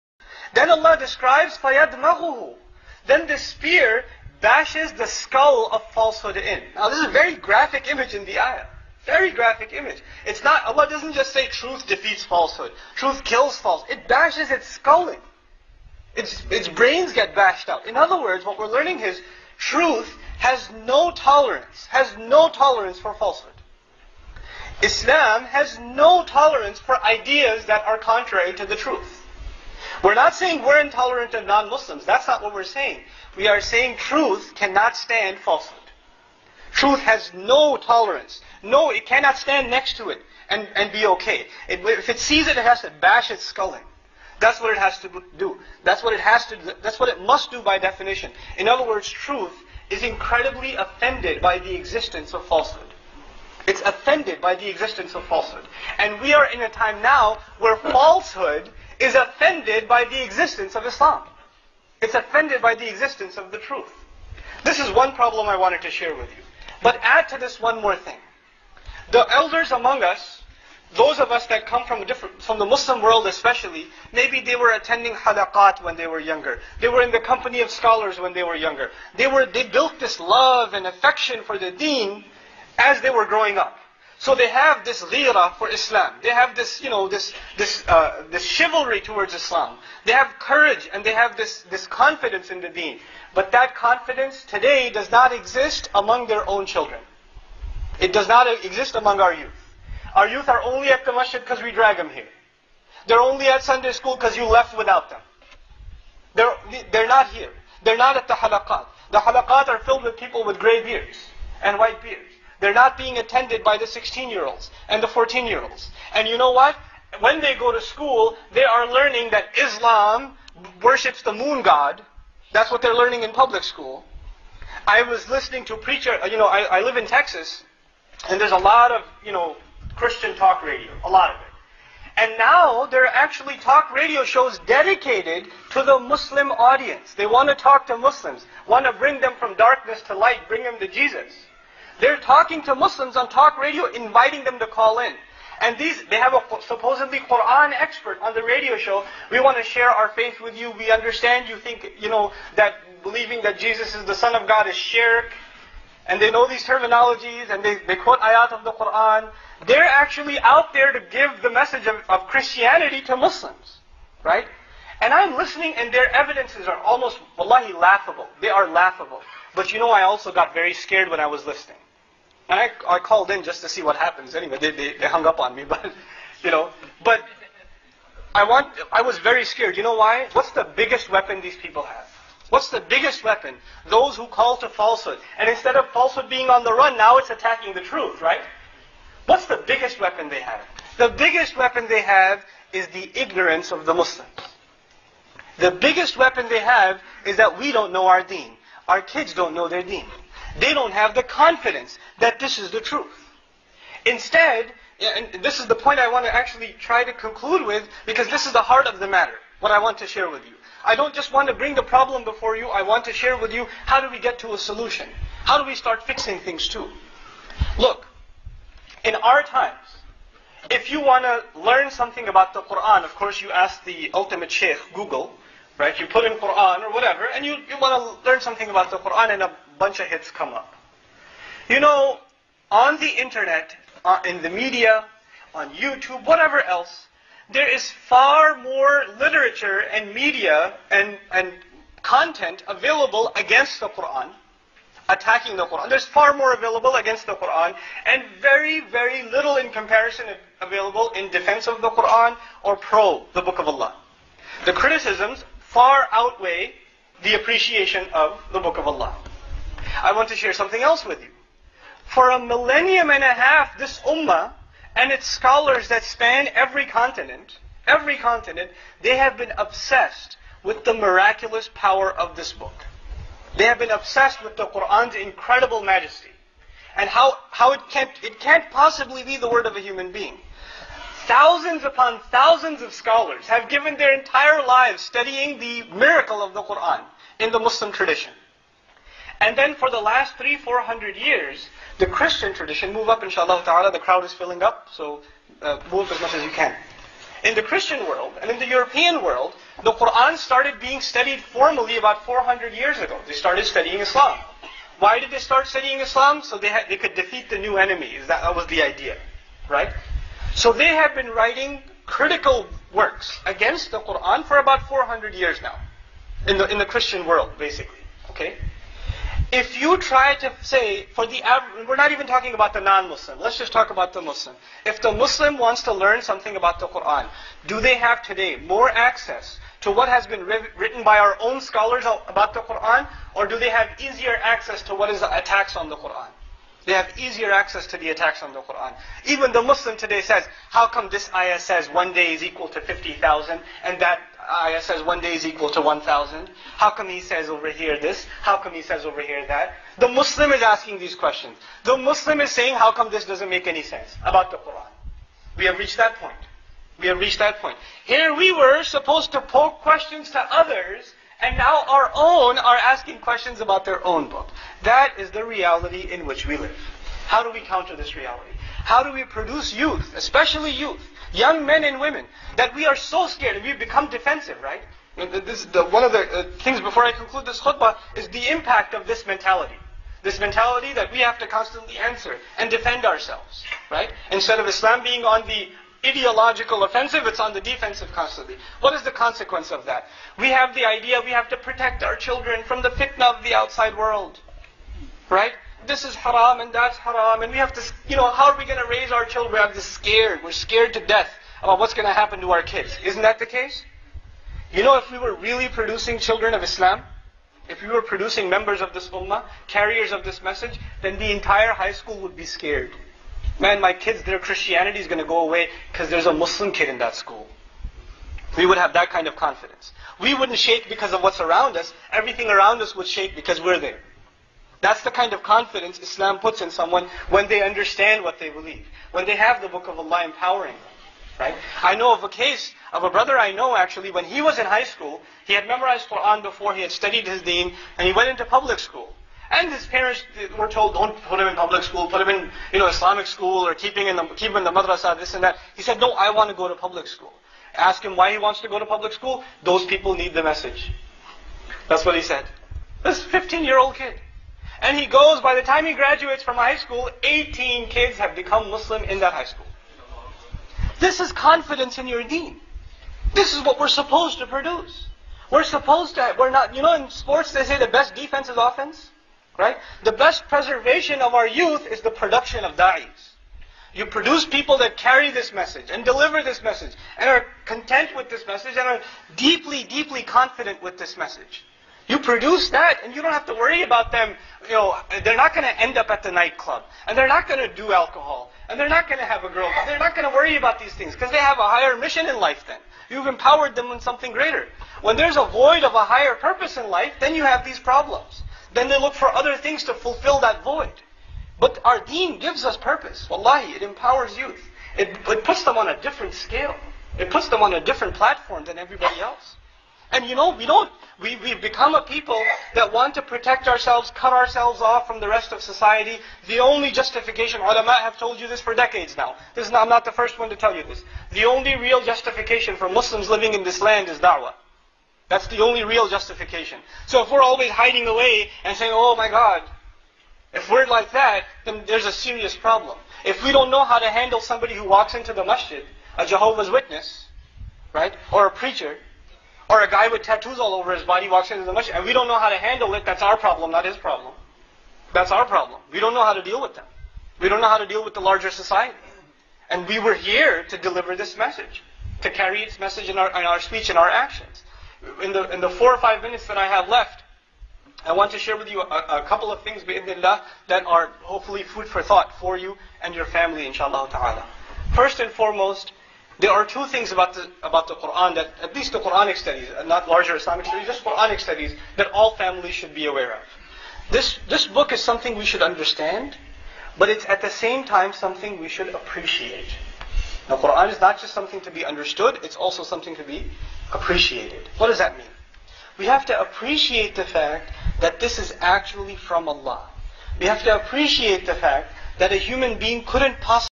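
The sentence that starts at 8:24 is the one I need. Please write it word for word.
It, it puts them on a different scale.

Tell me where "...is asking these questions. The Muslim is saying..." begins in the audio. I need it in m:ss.
5:50.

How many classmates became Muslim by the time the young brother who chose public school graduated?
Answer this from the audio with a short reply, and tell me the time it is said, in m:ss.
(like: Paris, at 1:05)
18, at 7:37.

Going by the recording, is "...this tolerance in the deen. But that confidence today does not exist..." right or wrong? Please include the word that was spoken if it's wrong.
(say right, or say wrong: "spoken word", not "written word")
wrong: "confidence", not "tolerance".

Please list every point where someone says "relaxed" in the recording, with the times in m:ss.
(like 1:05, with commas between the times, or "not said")
not said.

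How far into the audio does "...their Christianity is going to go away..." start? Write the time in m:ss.
6:54.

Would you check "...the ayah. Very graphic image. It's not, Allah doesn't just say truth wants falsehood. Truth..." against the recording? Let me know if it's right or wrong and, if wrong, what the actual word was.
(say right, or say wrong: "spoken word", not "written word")
wrong: "defeats", not "wants".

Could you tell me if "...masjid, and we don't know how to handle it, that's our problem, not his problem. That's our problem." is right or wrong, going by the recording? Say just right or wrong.
right.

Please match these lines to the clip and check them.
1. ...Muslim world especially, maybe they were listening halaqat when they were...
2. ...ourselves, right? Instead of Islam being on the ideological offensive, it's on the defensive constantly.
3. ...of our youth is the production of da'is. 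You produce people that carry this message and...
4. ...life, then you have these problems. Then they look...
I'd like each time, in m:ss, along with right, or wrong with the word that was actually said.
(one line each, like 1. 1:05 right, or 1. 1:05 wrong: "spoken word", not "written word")
1. 1:12 wrong: "attending", not "listening"
2. 6:23 right
3. 7:51 right
4. 8:16 right.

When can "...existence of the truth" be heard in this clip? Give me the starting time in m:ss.
1:02.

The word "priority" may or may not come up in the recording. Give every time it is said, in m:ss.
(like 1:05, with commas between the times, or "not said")
not said.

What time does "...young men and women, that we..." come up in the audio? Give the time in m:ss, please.
6:11.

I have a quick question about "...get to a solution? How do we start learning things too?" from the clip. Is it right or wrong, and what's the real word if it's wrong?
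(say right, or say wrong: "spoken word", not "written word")
wrong: "fixing", not "learning".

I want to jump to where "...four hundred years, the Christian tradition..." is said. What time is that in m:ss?
4:50.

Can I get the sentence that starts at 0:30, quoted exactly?
We're not saying we're intolerant of non-Muslims.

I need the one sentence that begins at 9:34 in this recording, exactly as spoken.
This, this book is something we should understand, but it's at the same time something we should appreciate.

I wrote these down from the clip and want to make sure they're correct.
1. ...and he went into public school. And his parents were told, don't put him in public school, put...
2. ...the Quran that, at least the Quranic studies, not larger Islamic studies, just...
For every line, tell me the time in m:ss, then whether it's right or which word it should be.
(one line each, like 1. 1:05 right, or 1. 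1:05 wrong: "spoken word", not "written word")
1. 7:17 right
2. 9:27 right.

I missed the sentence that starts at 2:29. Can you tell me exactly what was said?
We want to share our faith with you.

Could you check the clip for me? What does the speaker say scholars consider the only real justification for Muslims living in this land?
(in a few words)
da'wah.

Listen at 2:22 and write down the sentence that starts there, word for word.
They're talking to Muslims on talk radio, inviting them to call in.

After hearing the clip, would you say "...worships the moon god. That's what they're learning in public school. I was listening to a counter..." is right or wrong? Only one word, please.
wrong.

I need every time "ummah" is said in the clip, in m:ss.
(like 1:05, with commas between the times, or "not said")
4:24, 6:49.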